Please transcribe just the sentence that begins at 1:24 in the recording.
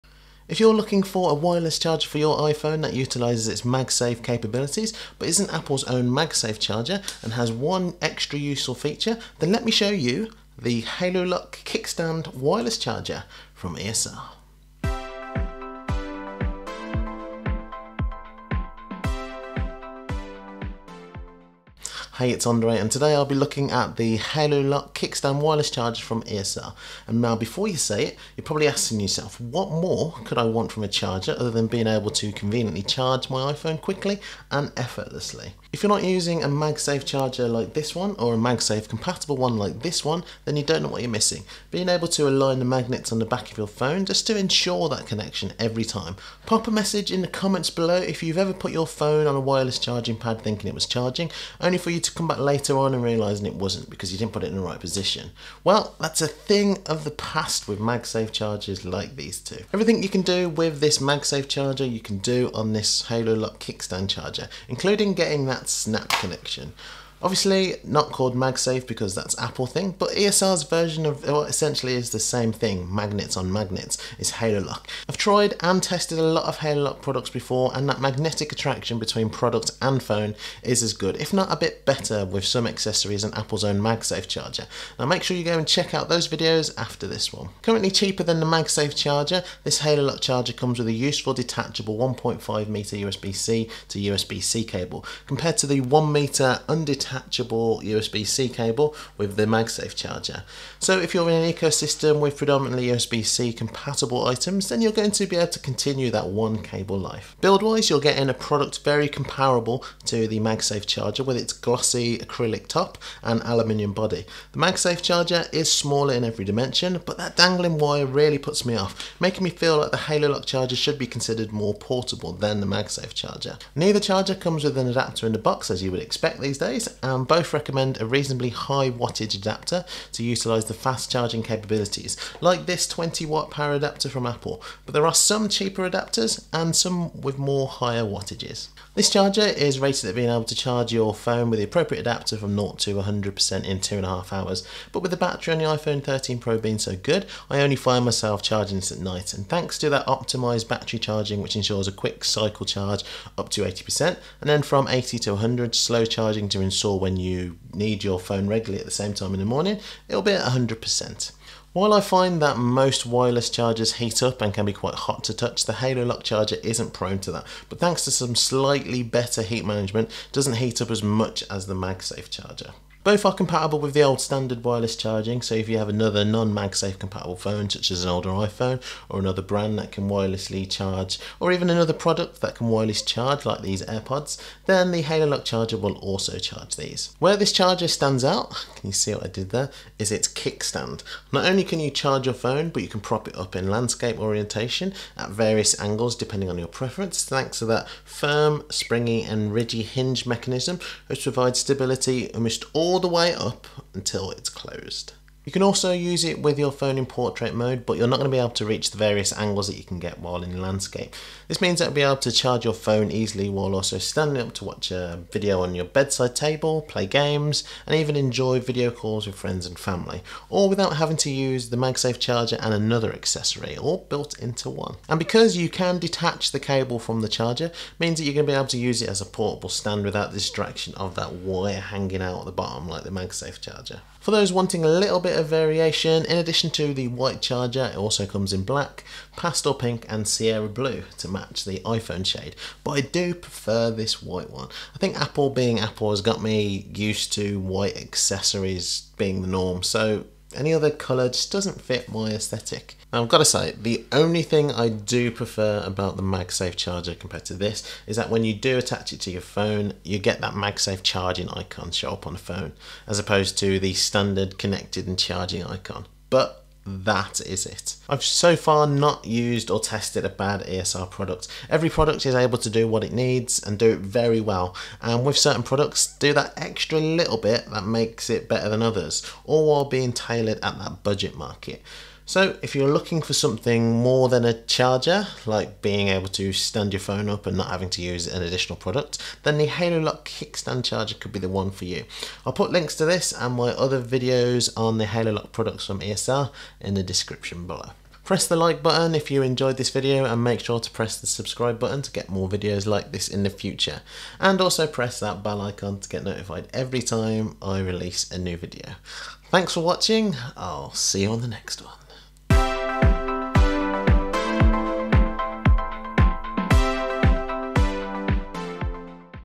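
Now make sure you go and check out those videos after this one.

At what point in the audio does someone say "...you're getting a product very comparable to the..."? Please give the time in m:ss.
1:47.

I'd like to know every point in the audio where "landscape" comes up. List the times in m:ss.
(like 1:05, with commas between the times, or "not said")
3:13, 3:30.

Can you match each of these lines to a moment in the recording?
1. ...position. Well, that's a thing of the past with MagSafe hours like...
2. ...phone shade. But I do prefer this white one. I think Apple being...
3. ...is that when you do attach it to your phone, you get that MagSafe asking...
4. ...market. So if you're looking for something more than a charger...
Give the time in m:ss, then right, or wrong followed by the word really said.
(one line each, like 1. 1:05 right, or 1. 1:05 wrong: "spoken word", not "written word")
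1. 0:54 wrong: "chargers", not "hours"
2. 4:01 wrong: "iPhone", not "phone"
3. 4:18 wrong: "charging", not "asking"
4. 4:41 right.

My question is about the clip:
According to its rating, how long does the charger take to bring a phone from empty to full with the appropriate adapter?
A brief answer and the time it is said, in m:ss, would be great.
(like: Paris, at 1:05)
2.5 hours, at 2:23.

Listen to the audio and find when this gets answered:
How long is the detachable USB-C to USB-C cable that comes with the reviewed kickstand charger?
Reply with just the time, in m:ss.
1:31.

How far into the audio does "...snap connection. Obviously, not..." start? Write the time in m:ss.
1:05.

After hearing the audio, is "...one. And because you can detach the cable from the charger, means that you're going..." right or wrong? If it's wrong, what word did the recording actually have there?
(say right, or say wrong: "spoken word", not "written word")
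right.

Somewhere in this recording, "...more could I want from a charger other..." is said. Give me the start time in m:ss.
0:29.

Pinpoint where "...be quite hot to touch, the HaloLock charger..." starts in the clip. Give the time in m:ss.
2:44.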